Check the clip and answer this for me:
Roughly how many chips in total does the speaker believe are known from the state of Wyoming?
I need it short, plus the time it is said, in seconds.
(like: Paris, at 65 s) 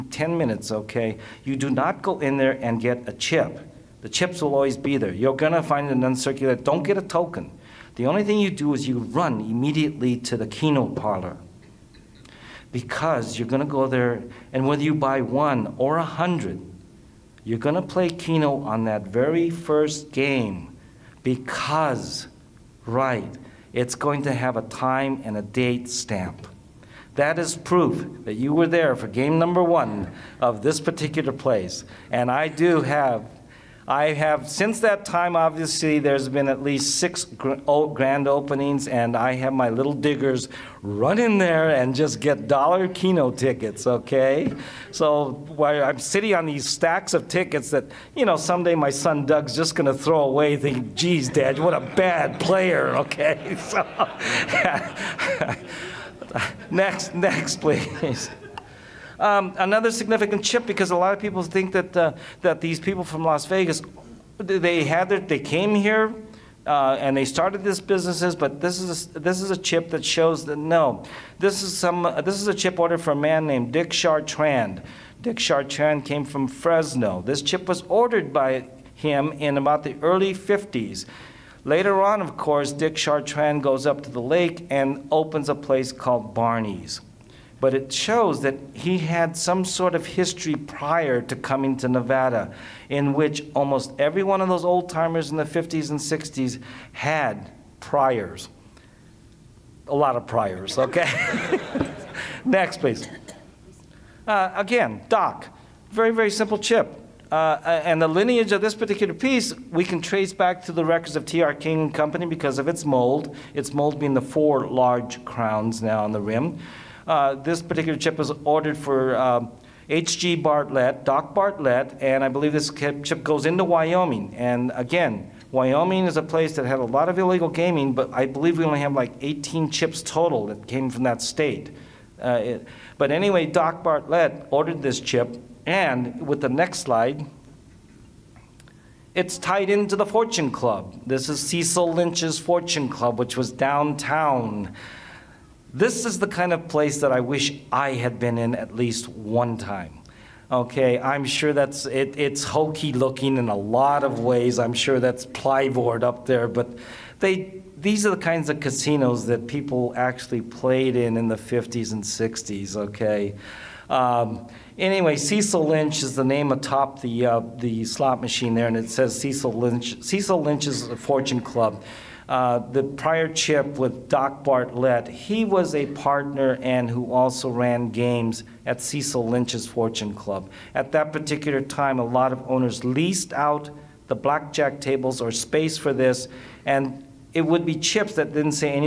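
18, at 129 s.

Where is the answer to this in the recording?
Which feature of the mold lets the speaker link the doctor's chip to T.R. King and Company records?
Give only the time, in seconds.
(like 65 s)
114 s.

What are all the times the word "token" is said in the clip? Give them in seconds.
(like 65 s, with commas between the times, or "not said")
7 s.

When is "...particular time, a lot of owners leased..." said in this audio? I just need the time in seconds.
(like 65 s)
181 s.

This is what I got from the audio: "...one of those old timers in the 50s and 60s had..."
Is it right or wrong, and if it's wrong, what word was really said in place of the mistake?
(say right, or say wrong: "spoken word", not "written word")
right.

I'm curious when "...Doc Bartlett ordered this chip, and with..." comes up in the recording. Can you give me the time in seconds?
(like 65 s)
133 s.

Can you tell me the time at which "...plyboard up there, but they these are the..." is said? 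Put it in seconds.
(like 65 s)
155 s.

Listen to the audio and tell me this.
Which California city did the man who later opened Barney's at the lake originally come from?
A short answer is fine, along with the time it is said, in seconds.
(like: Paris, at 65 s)
Fresno, at 76 s.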